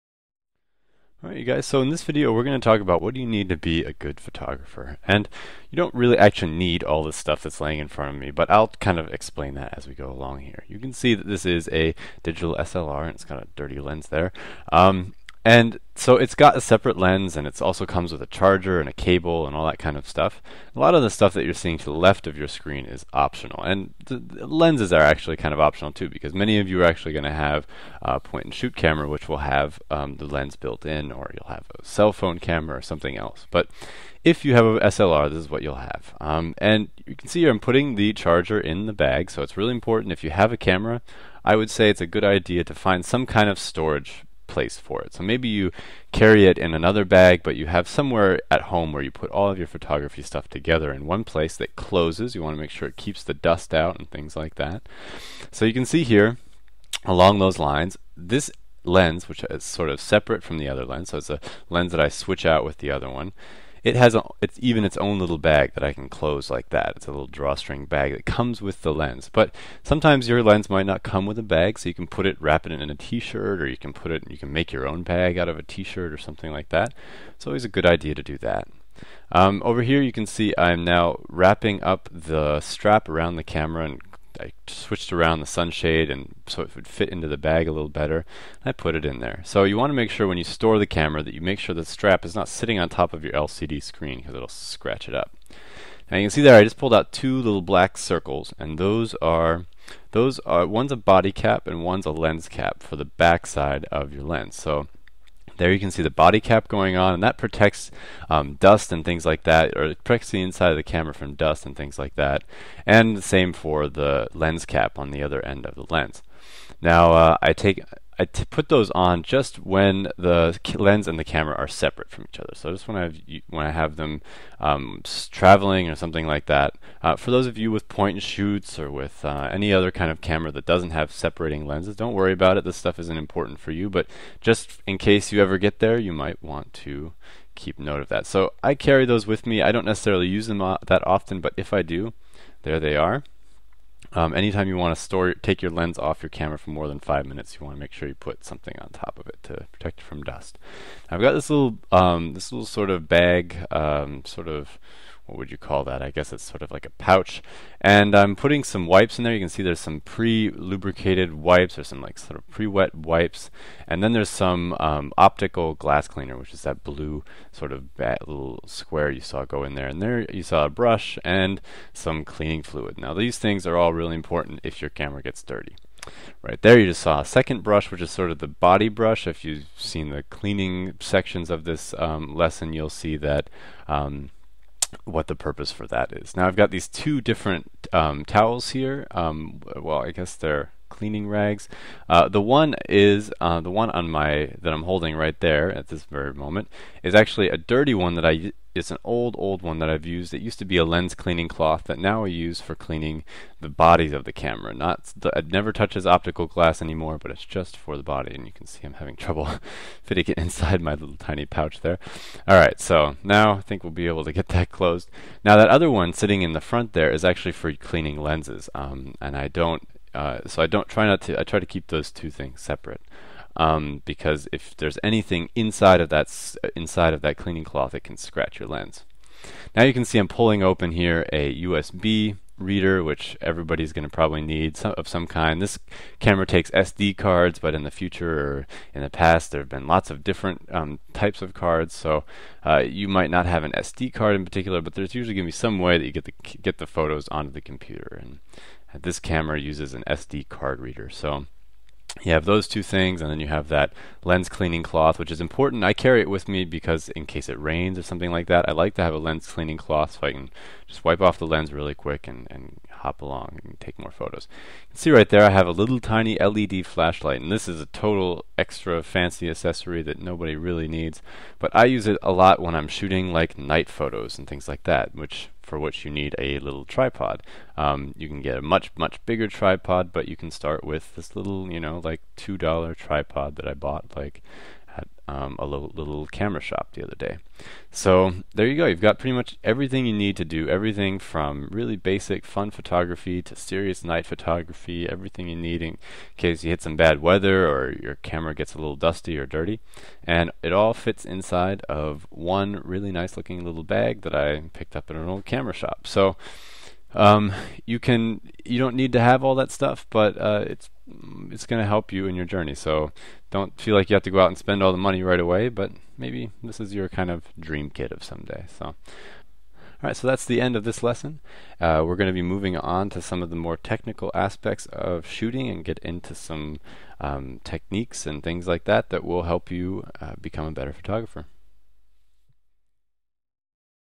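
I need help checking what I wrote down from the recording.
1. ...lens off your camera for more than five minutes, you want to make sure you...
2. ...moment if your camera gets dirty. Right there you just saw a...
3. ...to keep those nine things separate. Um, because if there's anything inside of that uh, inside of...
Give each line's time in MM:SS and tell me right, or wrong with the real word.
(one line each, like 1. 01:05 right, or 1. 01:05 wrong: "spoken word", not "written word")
1. 02:25 right
2. 02:54 wrong: "important", not "moment"
3. 03:41 wrong: "two", not "nine".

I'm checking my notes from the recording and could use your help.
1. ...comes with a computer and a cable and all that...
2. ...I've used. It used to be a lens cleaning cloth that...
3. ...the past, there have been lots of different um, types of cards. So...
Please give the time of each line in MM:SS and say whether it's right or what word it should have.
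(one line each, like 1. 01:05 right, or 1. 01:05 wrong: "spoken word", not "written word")
1. 00:17 wrong: "charger", not "computer"
2. 03:19 right
3. 03:59 right.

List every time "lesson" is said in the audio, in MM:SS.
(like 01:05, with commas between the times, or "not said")
03:02, 05:21.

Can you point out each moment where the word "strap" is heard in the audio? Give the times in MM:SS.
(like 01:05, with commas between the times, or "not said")
01:22, 01:31.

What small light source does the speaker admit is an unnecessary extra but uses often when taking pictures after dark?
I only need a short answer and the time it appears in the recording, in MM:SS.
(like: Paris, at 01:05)
LED flashlight, at 04:26.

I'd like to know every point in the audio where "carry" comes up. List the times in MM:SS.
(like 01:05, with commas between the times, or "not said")
00:46, 02:18, 04:15.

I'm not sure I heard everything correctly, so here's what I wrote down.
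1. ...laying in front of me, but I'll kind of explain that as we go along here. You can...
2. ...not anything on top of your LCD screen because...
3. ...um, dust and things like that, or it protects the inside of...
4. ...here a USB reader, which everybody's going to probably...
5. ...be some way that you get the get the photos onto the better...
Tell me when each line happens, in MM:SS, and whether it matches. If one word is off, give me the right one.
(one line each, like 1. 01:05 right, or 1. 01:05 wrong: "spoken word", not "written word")
1. 00:07 right
2. 01:32 wrong: "sitting", not "anything"
3. 01:48 right
4. 03:50 right
5. 04:05 wrong: "computer", not "better".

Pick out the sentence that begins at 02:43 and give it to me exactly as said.
And then there's some um, optical glass cleaner, which is that blue sort of little square you saw go in there.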